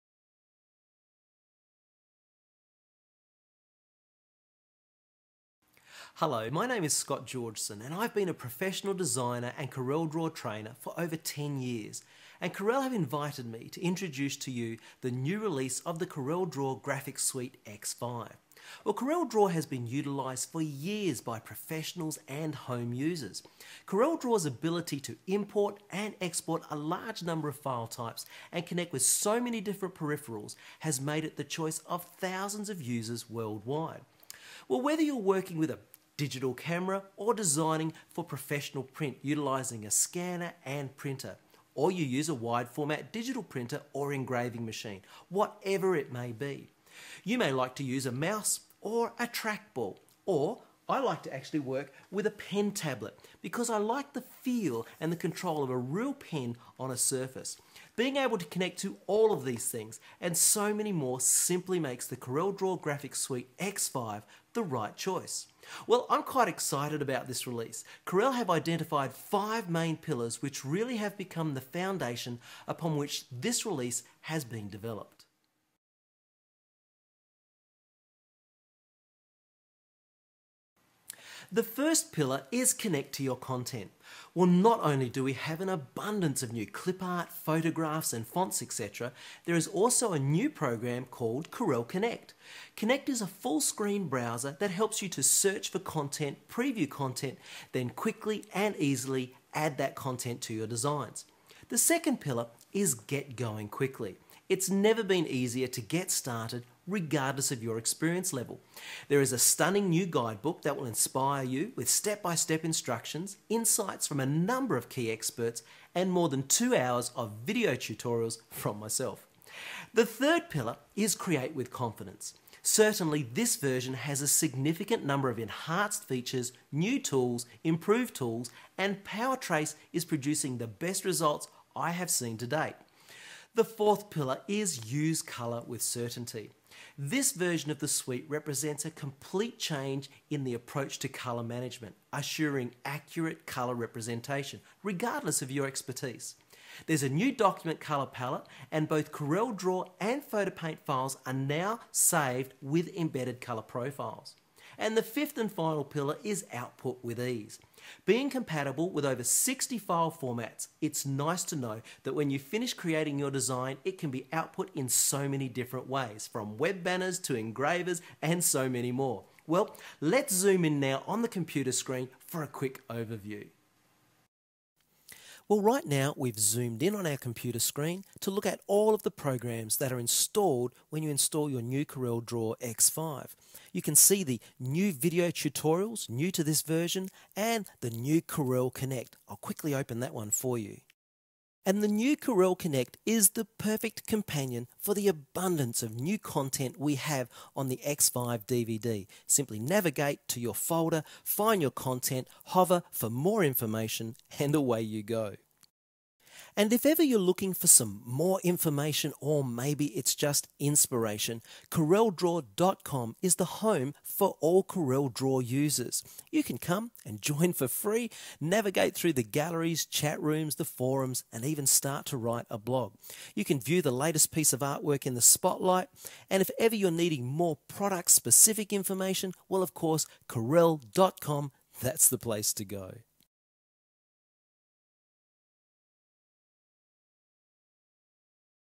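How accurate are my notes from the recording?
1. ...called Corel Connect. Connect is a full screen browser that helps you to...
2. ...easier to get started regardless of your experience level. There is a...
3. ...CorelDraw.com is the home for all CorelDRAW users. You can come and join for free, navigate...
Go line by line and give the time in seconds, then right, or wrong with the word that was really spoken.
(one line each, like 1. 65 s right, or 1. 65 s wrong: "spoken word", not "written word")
1. 91 s right
2. 105 s right
3. 211 s right.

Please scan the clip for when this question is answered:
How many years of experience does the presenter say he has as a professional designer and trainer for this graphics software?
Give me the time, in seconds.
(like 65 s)
10 s.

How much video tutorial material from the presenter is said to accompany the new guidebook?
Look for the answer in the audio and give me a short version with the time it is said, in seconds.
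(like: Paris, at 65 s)
more than 2 hours, at 116 s.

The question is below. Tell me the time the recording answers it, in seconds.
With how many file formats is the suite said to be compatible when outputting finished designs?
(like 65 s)
159 s.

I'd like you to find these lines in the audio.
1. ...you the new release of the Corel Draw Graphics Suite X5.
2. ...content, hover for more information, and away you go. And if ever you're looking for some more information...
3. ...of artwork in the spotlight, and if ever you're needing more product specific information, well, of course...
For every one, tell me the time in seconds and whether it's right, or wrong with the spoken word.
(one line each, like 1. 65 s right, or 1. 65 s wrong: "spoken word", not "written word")
1. 14 s right
2. 201 s right
3. 224 s right.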